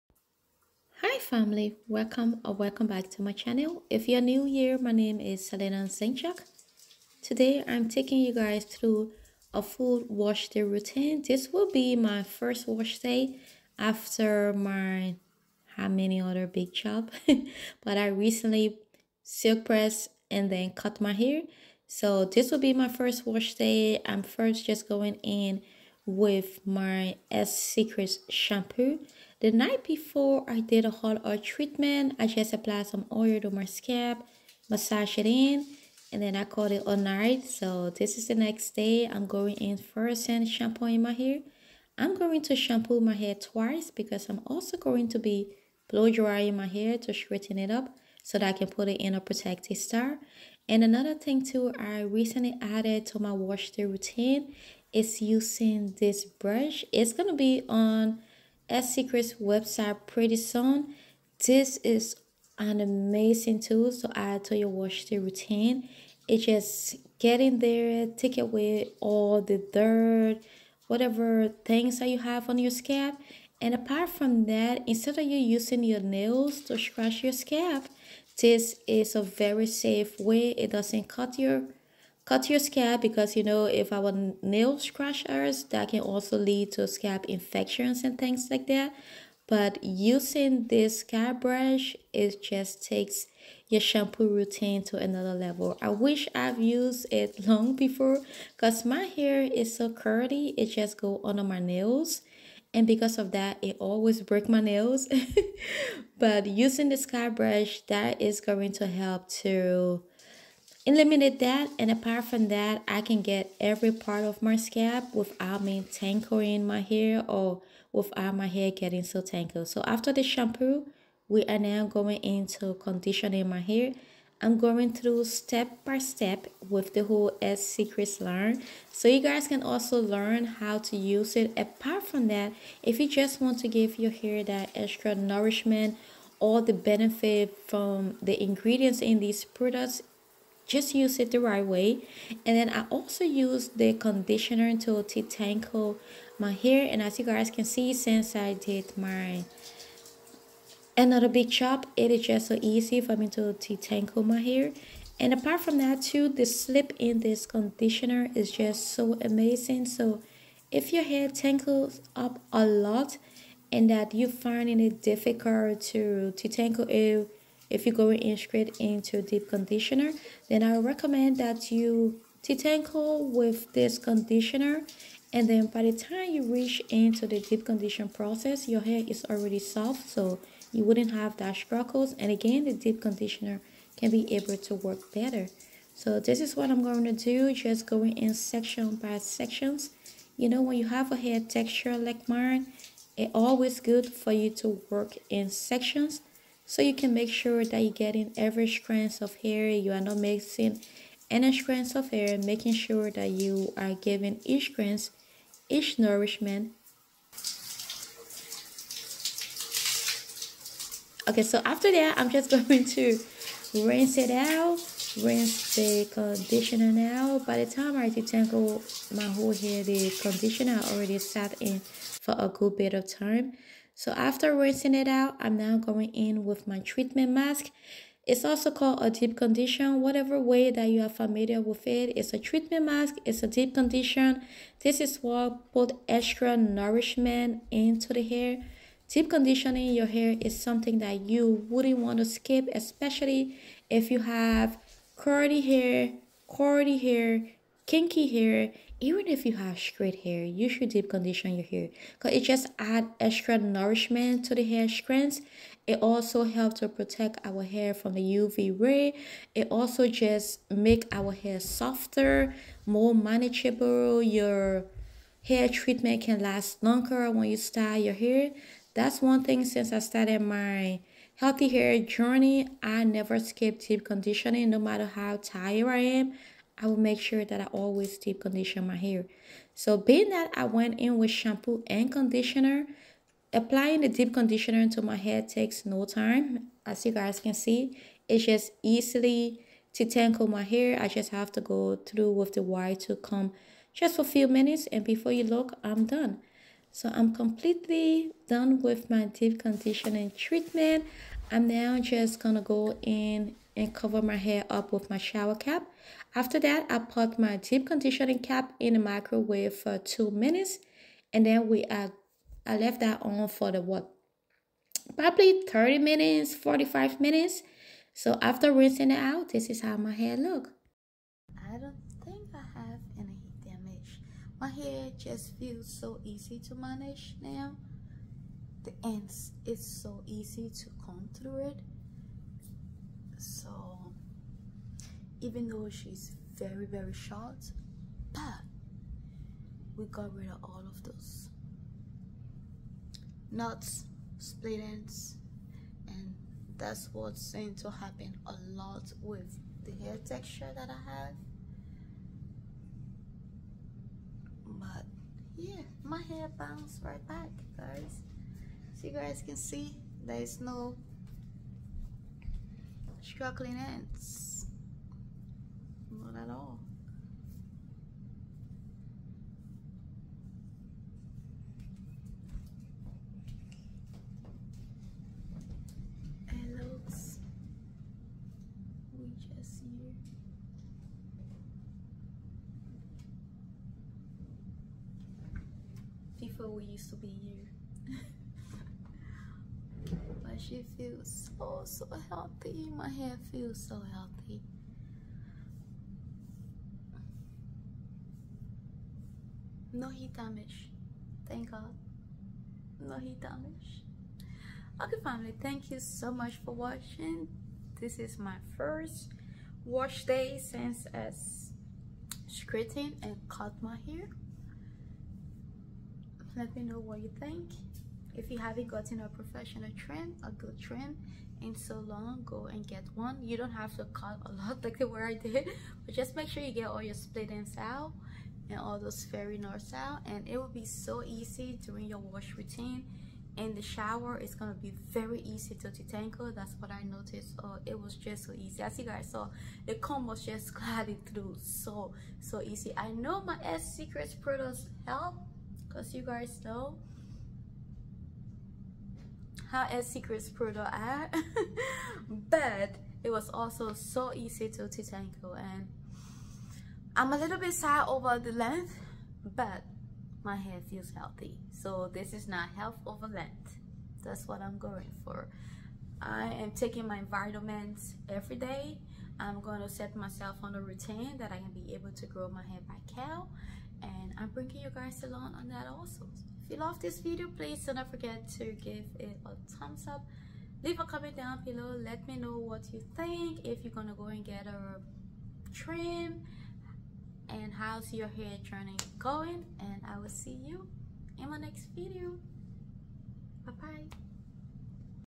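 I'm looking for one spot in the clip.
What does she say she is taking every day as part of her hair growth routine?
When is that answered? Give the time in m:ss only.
7:47.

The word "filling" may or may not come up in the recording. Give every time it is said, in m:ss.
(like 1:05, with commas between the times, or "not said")
not said.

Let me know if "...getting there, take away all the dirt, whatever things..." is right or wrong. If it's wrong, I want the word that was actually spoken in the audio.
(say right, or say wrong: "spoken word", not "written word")
right.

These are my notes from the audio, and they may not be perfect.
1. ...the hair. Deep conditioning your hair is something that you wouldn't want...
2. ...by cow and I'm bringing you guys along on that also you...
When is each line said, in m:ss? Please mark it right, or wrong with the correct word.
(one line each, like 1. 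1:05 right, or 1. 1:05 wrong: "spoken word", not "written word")
1. 3:58 right
2. 7:52 right.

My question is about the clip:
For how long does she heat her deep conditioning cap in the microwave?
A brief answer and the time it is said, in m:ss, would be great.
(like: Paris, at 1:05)
2 minutes, at 5:09.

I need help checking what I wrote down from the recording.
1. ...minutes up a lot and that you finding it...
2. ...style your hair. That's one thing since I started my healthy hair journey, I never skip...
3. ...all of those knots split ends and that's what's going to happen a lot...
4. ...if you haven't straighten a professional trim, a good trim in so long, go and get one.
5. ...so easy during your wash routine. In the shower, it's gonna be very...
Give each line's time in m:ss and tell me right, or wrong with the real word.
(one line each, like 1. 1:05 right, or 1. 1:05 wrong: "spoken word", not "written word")
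1. 2:41 wrong: "tangles", not "minutes"
2. 4:27 right
3. 5:40 right
4. 6:58 wrong: "gotten", not "straighten"
5. 7:10 right.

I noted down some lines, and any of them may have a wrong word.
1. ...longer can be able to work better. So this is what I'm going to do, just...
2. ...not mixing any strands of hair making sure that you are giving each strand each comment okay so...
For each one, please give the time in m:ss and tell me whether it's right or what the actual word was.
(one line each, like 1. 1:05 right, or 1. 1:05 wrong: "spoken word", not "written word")
1. 3:03 wrong: "conditioner", not "longer"
2. 3:19 wrong: "nourishment", not "comment".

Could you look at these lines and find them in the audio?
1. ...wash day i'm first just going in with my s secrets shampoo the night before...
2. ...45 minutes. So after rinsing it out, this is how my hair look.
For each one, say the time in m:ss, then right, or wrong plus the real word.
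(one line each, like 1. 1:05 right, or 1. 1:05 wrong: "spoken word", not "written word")
1. 0:23 right
2. 5:16 right.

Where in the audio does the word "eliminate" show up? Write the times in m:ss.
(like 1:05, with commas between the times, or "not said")
1:50.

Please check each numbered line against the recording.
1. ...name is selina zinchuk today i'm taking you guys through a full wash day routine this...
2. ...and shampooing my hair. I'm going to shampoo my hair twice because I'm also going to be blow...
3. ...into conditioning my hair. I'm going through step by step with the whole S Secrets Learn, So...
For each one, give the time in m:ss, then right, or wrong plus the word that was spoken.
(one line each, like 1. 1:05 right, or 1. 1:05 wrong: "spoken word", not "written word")
1. 0:04 right
2. 0:40 right
3. 2:02 right.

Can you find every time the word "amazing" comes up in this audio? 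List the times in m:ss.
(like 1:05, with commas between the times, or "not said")
1:02, 2:39.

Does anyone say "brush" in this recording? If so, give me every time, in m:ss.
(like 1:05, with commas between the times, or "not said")
0:56, 1:31, 1:47.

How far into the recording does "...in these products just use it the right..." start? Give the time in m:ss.
2:18.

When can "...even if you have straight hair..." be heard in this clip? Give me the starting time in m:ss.
4:08.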